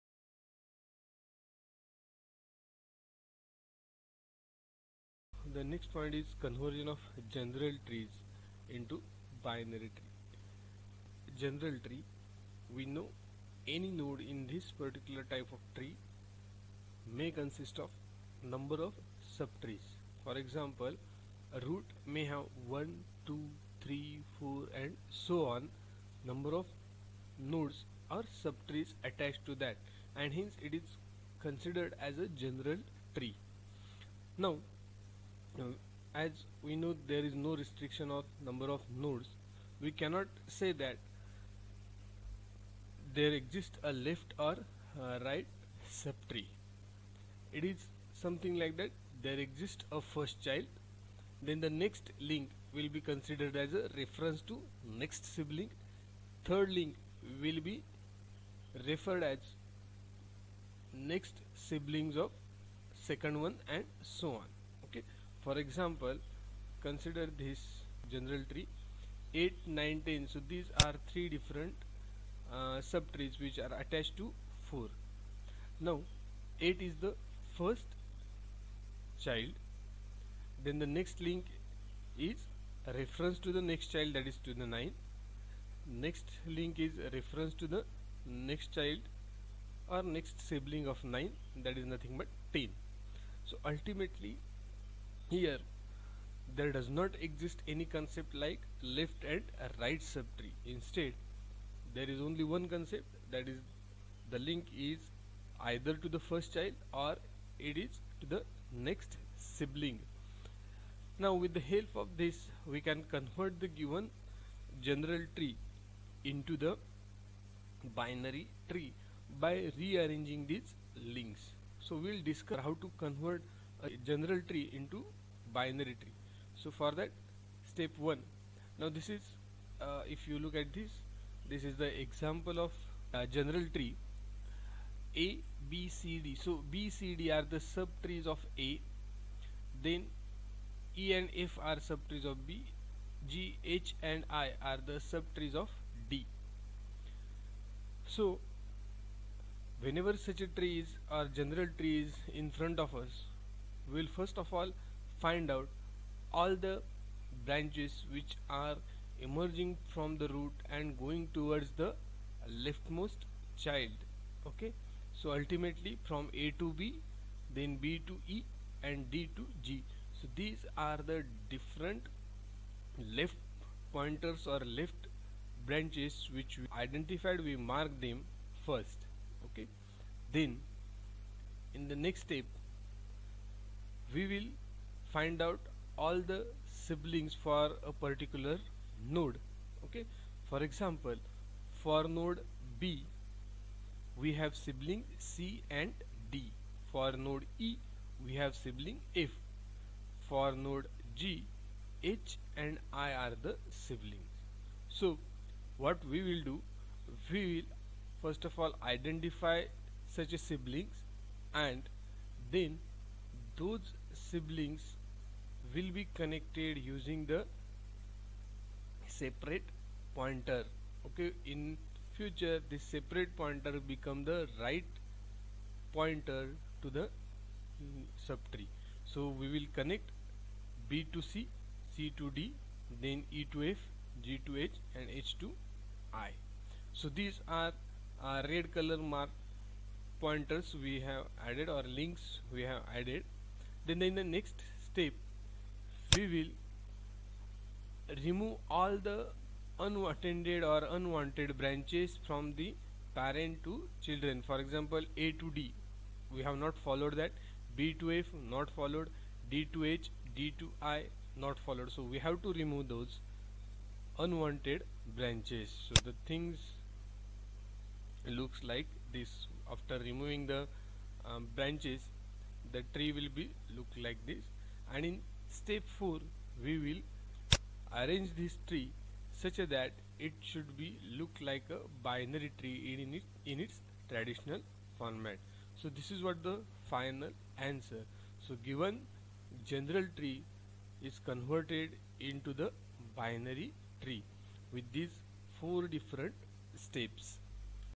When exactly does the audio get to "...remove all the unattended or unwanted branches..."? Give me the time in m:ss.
4:08.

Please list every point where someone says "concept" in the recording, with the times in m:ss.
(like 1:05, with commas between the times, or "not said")
1:37, 1:42.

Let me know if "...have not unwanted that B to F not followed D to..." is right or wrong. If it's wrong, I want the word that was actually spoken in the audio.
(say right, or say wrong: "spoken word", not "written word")
wrong: "followed", not "unwanted".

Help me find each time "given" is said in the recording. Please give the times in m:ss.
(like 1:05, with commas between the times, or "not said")
1:53, 4:48.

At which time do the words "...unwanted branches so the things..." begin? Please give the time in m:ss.
4:24.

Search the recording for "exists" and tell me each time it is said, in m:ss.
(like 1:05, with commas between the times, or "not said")
0:43, 0:49, 1:37.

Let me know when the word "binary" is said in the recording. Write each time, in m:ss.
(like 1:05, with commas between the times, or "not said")
0:09, 1:58, 2:05, 4:42, 4:53.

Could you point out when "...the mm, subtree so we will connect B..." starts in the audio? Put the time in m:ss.
3:46.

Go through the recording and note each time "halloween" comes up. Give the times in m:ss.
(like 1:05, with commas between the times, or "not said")
not said.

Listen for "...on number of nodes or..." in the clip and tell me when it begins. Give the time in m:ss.
0:25.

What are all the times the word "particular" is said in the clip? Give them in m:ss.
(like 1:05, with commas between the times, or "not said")
0:14, 3:08.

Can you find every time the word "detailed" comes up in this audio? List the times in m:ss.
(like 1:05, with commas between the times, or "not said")
not said.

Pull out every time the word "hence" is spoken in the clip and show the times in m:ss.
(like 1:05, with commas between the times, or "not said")
0:30.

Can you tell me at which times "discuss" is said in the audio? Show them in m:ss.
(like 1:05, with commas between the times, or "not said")
2:02.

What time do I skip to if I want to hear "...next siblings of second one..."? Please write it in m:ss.
1:01.